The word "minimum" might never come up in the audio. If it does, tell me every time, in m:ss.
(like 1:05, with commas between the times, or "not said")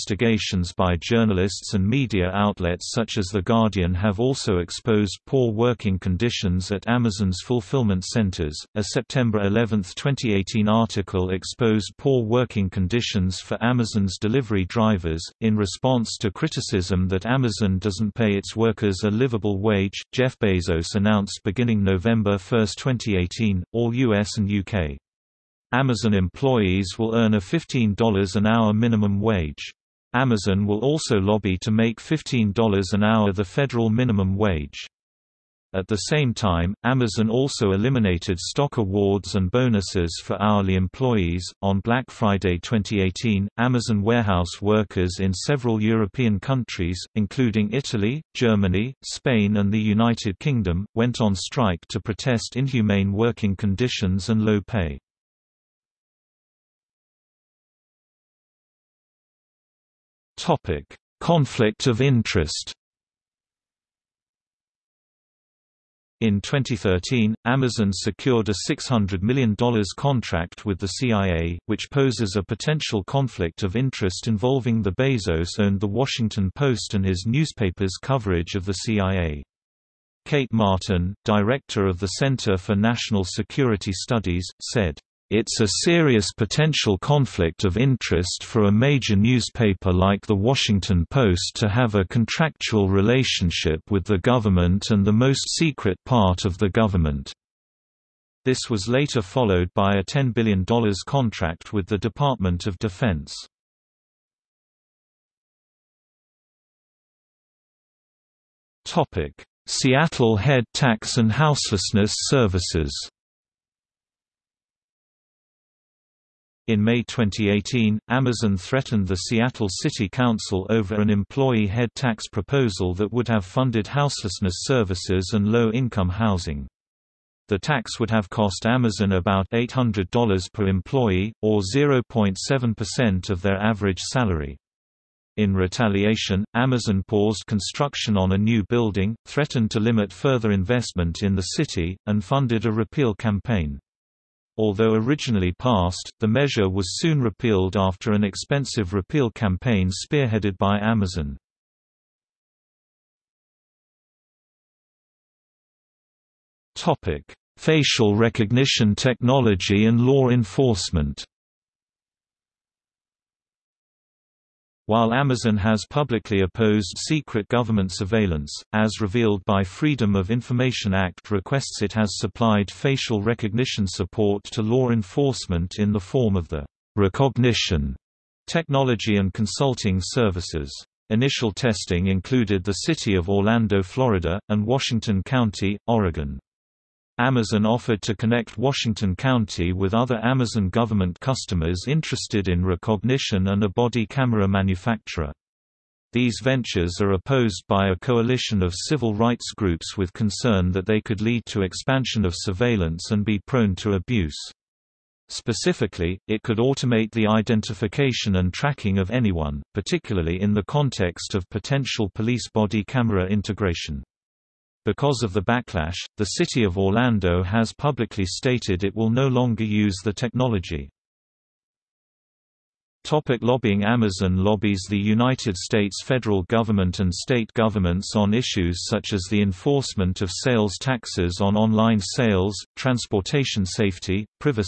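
0:28, 0:33.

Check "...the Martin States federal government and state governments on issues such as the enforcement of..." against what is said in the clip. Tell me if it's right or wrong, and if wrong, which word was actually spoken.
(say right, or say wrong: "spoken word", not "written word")
wrong: "United", not "Martin".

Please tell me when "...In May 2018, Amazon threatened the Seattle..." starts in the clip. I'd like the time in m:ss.
1:56.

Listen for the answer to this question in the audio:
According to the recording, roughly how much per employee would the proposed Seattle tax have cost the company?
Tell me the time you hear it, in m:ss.
2:09.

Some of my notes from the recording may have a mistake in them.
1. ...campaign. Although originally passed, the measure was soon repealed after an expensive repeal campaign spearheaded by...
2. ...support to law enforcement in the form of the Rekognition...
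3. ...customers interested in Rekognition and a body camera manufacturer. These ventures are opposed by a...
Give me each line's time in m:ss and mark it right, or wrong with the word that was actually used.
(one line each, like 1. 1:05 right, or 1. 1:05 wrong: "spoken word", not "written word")
1. 2:23 right
2. 2:53 right
3. 3:11 right.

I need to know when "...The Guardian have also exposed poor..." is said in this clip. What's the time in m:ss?
0:03.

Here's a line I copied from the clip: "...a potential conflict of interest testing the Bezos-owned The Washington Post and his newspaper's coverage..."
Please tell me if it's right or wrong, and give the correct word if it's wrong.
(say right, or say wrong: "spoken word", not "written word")
wrong: "involving", not "testing".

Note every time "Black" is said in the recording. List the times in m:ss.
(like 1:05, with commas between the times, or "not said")
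0:41.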